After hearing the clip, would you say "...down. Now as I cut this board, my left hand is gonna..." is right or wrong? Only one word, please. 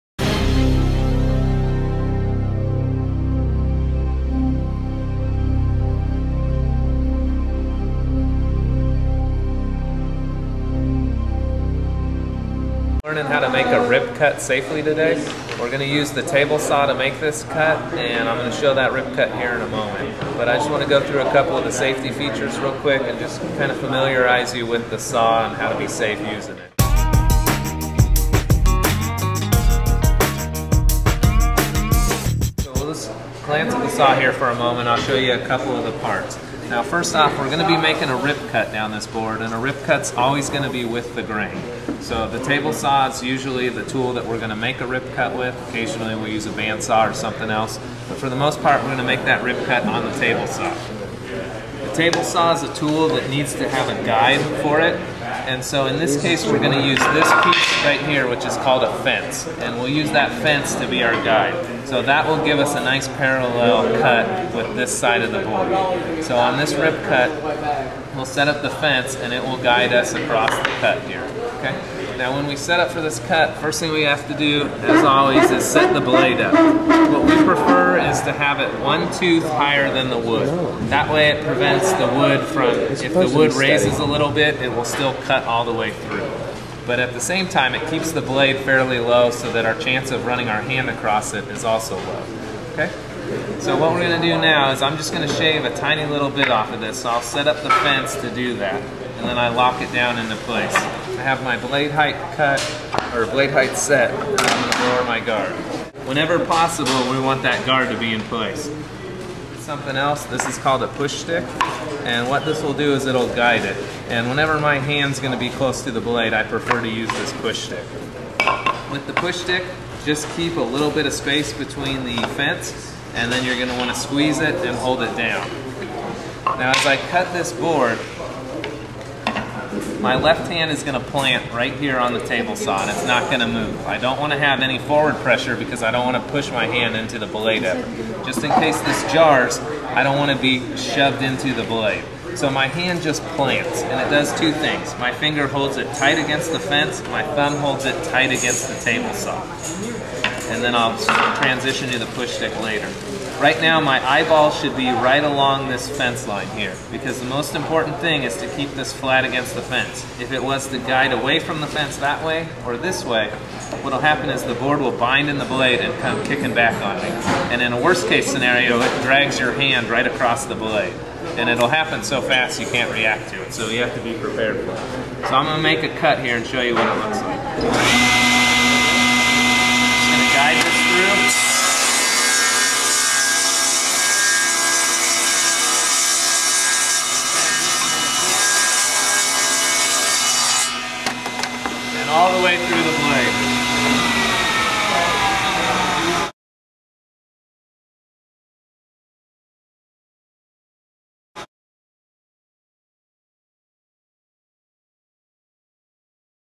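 right.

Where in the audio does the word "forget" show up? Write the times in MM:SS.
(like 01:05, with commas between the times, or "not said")
not said.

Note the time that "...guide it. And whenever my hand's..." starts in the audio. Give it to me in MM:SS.
01:53.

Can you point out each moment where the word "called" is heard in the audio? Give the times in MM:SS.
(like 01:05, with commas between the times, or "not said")
00:58, 01:50.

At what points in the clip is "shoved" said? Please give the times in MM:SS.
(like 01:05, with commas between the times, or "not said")
02:20.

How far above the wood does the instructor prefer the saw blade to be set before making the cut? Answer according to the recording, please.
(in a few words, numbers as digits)
one tooth higher.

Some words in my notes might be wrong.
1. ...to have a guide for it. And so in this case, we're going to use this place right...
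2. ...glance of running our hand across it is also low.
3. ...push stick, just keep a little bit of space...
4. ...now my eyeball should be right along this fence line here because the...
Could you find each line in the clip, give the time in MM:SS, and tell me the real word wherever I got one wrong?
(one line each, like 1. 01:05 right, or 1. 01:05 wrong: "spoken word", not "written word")
1. 00:53 wrong: "piece", not "place"
2. 01:29 wrong: "chance", not "glance"
3. 01:59 right
4. 02:33 right.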